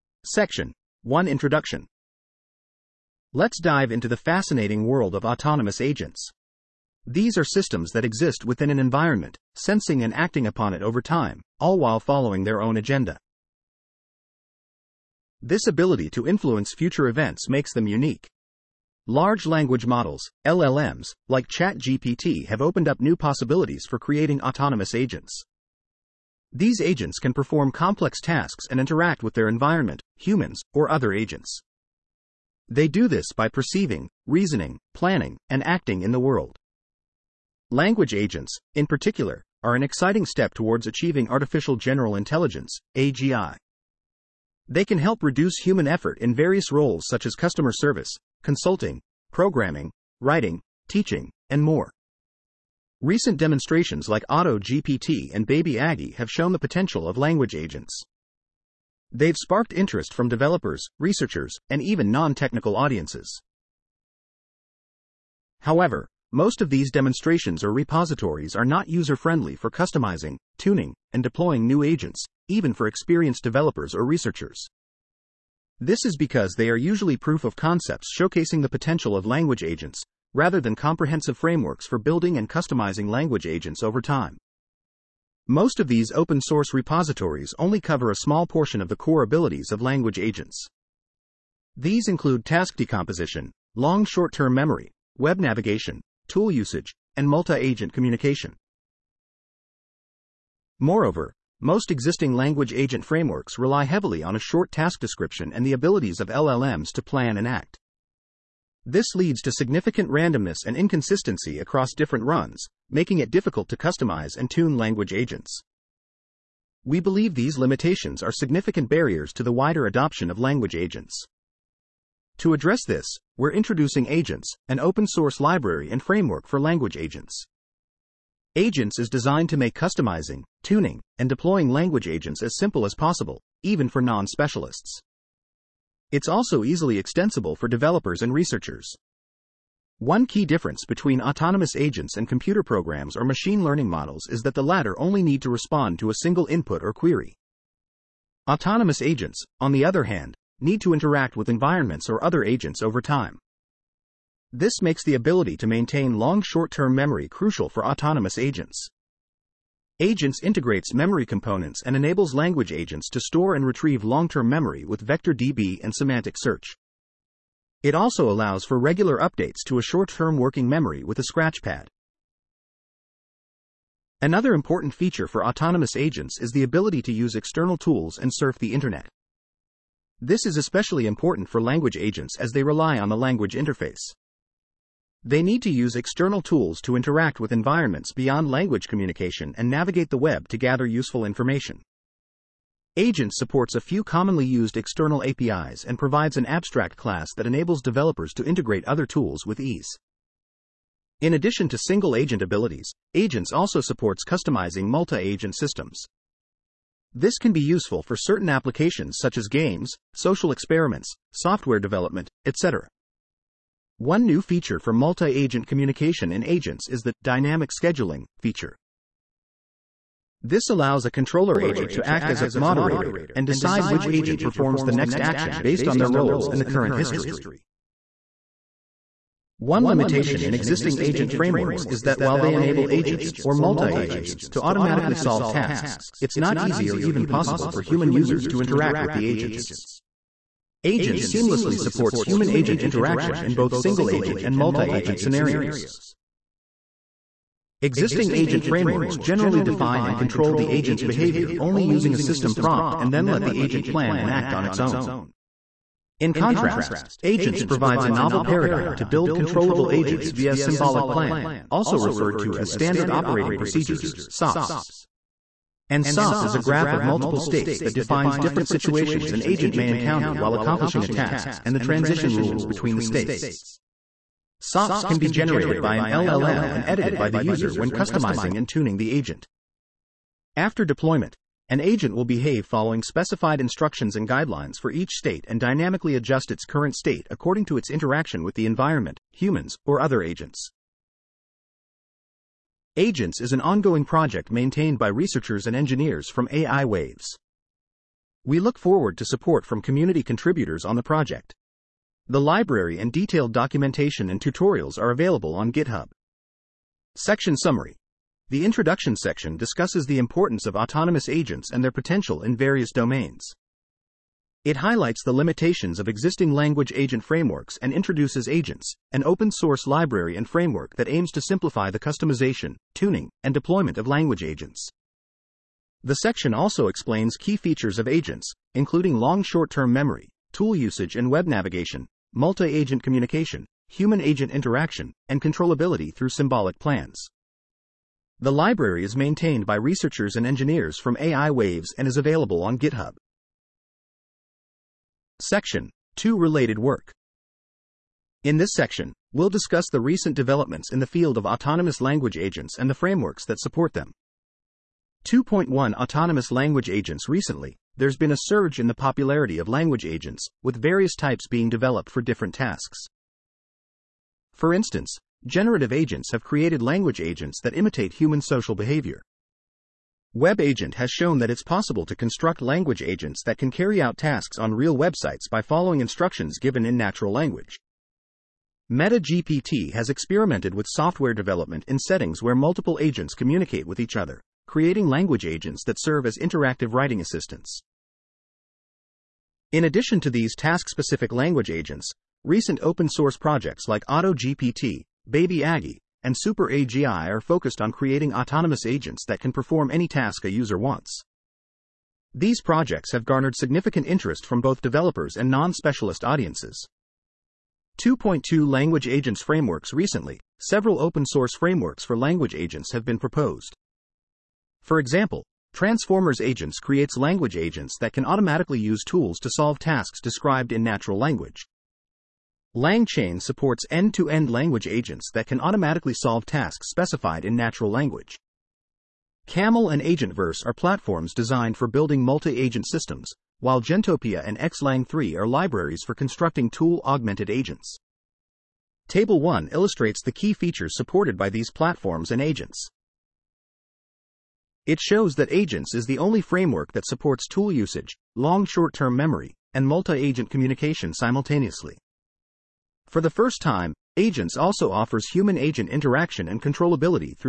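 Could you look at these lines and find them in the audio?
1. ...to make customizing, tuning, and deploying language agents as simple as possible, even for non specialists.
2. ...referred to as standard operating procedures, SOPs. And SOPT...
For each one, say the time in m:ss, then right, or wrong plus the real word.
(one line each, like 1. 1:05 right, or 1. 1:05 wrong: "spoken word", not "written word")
1. 2:09 right
2. 4:21 right.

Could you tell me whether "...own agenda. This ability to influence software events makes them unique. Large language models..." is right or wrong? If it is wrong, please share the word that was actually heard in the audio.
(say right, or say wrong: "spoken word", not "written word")
wrong: "future", not "software".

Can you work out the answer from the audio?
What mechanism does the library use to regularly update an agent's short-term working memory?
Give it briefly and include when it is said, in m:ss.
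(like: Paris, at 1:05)
a scratchpad, at 2:51.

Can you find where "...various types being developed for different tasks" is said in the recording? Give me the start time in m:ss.
6:00.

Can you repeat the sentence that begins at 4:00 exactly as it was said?
Agent seamlessly supports human agent interaction in both single agent and multi agent scenarios.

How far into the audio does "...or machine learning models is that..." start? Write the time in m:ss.
2:23.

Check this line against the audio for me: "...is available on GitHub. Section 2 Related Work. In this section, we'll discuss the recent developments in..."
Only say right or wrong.
right.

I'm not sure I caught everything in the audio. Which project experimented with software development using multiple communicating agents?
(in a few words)
MetaGPT.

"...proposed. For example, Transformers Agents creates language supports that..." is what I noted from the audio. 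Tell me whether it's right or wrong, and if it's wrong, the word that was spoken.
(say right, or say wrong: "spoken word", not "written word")
wrong: "agents", not "supports".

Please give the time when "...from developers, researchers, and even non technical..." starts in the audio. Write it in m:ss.
1:00.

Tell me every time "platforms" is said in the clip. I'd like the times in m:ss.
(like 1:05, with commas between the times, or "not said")
7:10, 7:21.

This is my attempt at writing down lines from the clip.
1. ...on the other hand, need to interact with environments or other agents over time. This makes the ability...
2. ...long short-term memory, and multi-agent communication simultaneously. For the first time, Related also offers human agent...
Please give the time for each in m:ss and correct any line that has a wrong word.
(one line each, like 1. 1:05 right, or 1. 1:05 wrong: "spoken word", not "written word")
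1. 2:29 right
2. 7:28 wrong: "Agents", not "Related".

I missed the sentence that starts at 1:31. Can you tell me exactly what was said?
These include task decomposition, long short term memory, web navigation, tool usage, and multi agent communication.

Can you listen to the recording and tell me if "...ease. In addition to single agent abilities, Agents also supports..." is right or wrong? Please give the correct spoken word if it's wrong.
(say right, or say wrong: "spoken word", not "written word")
right.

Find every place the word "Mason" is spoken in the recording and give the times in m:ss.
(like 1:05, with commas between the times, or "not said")
not said.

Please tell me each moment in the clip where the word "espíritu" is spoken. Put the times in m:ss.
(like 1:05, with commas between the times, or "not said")
not said.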